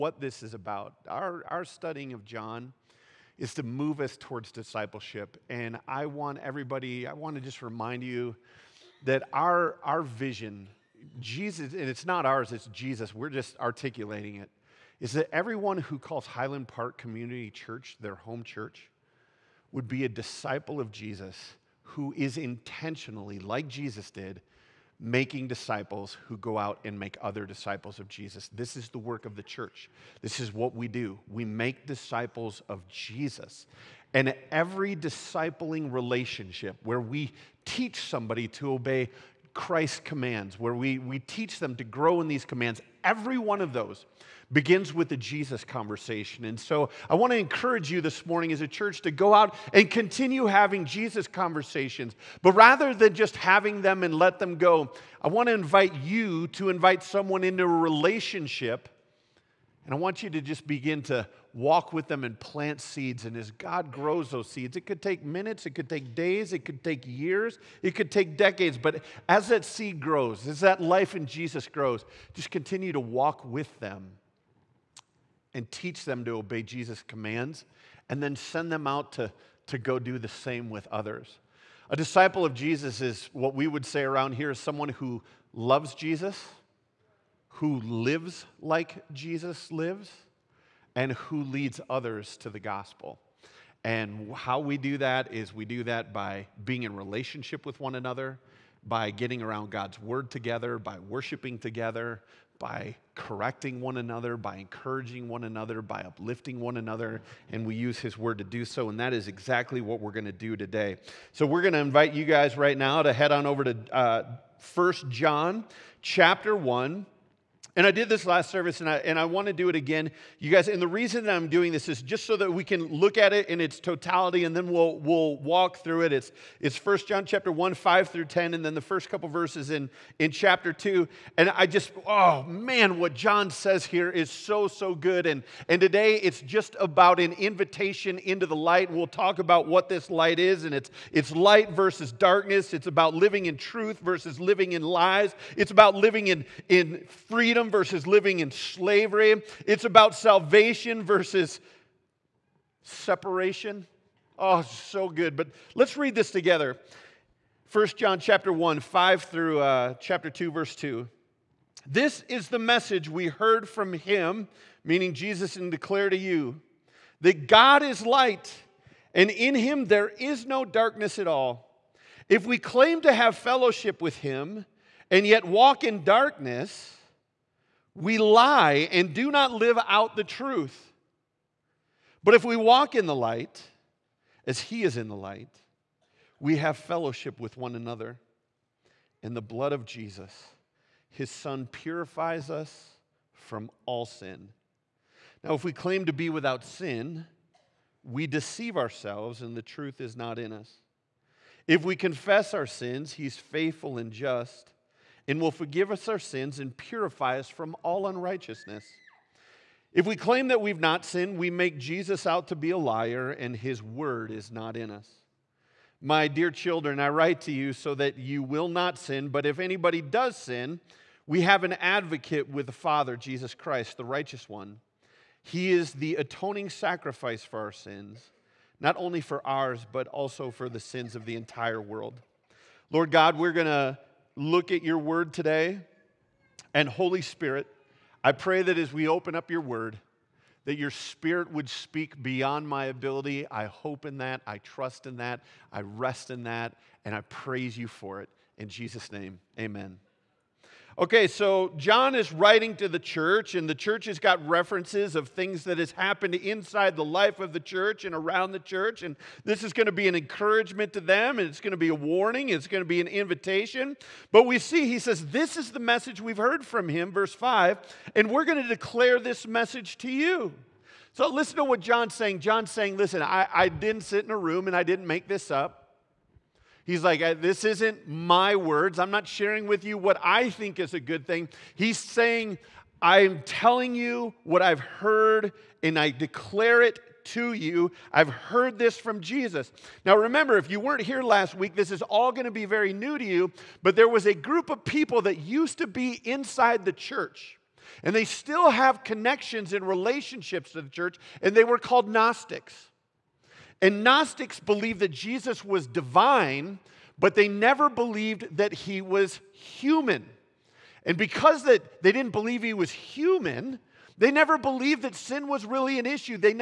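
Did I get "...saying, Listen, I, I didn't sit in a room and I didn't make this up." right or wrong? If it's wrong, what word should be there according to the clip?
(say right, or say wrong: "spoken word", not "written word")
right.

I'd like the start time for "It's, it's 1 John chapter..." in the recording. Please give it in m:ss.
2:06.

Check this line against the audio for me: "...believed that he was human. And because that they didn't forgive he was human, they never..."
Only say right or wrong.
wrong.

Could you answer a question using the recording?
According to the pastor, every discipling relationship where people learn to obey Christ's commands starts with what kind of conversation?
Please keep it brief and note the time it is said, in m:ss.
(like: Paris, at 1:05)
The Jesus conversation, at 0:45.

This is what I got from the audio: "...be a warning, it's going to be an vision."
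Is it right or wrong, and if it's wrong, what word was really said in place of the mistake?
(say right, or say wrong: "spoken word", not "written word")
wrong: "invitation", not "vision".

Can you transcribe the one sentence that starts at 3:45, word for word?
He is the atoning sacrifice for our sins, not only for ours, but also for the sins of the entire world.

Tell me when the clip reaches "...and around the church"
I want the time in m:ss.
4:18.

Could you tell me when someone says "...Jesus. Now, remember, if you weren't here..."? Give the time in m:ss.
4:49.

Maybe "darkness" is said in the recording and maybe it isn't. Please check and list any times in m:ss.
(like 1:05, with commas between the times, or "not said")
2:22, 2:50, 2:56.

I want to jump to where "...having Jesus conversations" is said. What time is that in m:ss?
0:50.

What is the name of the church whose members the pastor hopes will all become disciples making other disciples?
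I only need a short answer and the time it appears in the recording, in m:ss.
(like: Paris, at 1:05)
Highland Park Community Church, at 0:16.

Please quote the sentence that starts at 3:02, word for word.
But if we walk in the light, as he is in the light, we have fellowship with one another.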